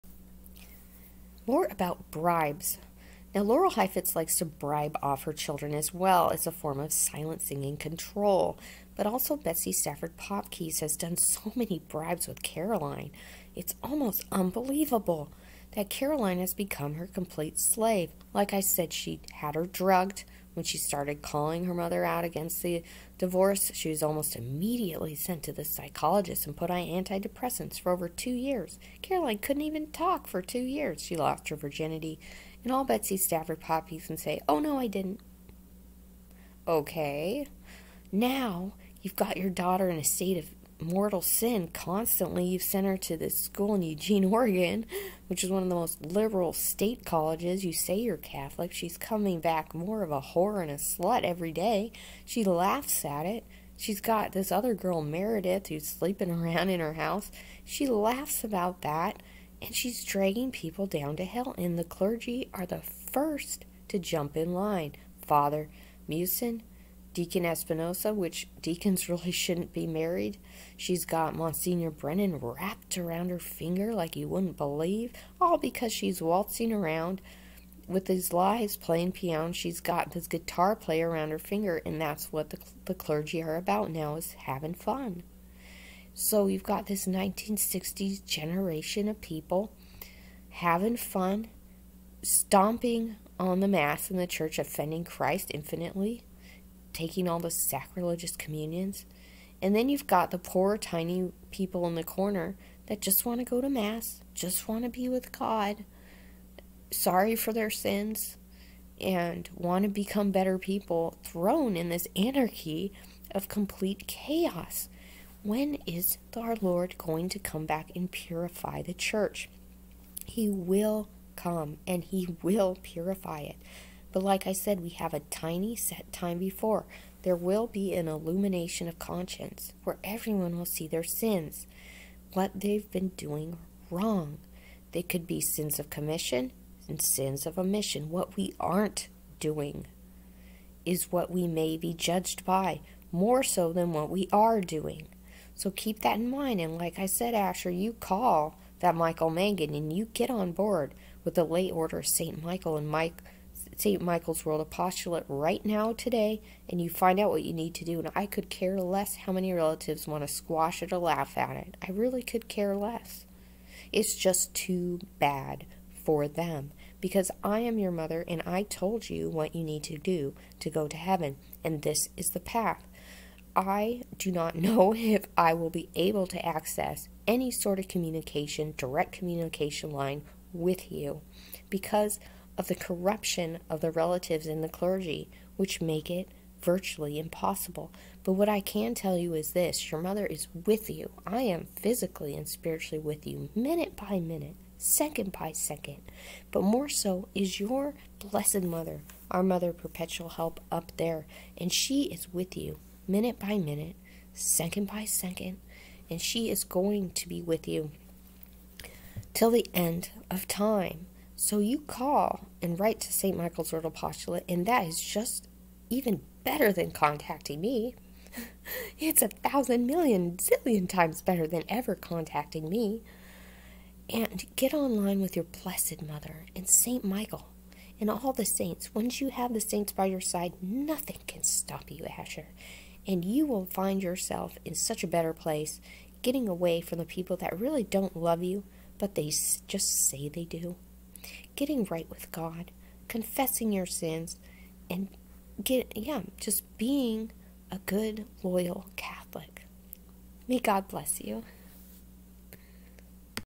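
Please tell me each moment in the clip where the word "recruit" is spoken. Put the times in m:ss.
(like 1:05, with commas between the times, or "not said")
not said.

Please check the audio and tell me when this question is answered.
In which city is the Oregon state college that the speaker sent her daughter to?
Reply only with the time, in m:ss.
0:43.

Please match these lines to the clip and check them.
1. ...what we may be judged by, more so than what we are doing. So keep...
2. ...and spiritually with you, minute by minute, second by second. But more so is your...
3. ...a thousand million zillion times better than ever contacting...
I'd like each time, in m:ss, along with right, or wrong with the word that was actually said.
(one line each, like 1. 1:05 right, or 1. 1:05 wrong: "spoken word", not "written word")
1. 2:21 right
2. 3:12 right
3. 3:39 right.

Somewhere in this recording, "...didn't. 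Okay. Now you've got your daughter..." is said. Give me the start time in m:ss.
0:34.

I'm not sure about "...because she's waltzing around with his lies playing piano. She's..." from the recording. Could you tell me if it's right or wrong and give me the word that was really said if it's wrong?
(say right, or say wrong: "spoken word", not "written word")
right.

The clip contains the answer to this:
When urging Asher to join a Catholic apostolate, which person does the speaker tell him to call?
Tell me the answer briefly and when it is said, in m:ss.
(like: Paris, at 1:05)
Michael Mangan, at 2:28.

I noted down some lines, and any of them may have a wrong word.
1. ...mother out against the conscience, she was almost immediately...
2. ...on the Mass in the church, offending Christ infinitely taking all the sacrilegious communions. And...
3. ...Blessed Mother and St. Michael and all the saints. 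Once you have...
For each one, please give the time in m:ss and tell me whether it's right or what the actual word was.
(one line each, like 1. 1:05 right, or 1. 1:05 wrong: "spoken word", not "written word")
1. 0:21 wrong: "divorce", not "conscience"
2. 1:33 right
3. 3:45 right.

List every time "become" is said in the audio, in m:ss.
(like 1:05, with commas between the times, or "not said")
0:16, 1:49.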